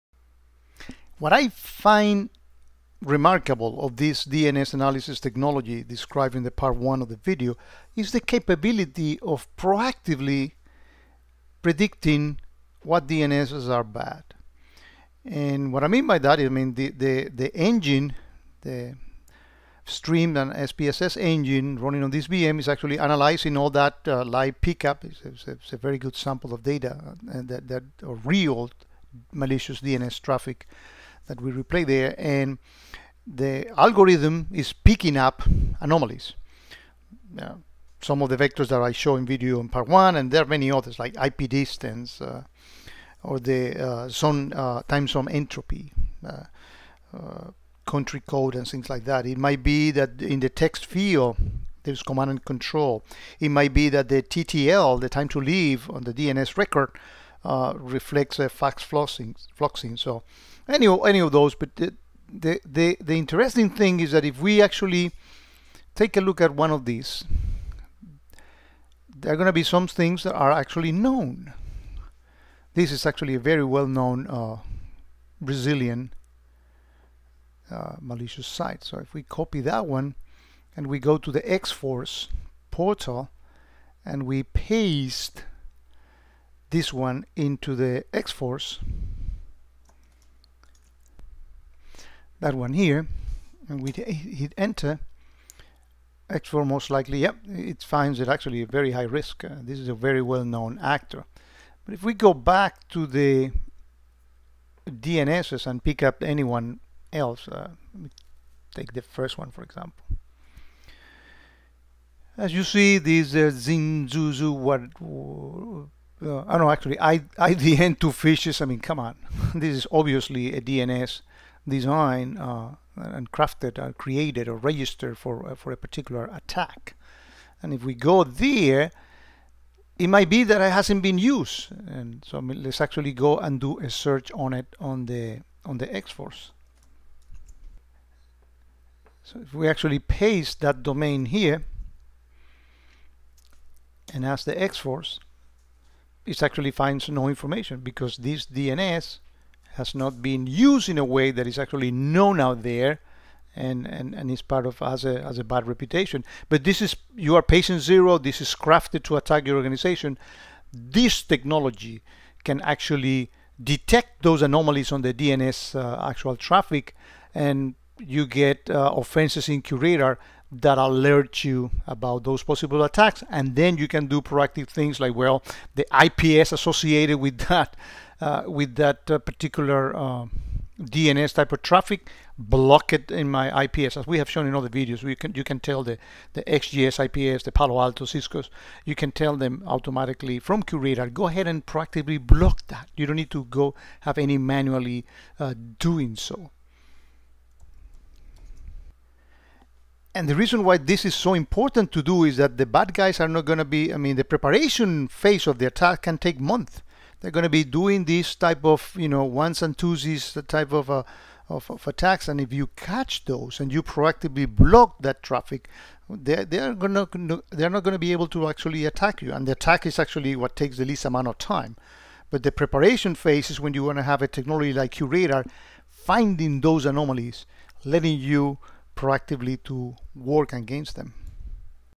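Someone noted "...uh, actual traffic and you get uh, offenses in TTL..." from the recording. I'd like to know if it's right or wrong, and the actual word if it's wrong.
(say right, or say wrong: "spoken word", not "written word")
wrong: "QRadar", not "TTL".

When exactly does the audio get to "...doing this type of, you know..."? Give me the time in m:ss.
3:27.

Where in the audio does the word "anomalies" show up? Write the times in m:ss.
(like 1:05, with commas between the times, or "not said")
0:35, 2:44, 3:46.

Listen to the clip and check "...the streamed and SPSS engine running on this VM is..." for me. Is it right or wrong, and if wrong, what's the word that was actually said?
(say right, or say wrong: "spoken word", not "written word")
right.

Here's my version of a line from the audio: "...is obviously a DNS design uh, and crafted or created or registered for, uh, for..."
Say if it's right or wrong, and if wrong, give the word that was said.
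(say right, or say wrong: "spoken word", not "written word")
right.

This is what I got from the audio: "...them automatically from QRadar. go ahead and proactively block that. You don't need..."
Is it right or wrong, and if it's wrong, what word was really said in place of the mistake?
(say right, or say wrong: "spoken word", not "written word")
right.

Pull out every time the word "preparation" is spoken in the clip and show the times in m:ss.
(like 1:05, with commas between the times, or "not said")
3:24, 3:42.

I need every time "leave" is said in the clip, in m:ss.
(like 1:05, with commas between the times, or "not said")
0:55.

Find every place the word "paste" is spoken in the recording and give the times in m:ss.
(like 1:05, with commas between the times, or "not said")
1:24, 2:19.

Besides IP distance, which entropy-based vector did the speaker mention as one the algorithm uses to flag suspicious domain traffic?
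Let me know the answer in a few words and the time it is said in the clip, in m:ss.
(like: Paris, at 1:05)
time zone entropy, at 0:44.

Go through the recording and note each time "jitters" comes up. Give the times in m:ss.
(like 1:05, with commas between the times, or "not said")
not said.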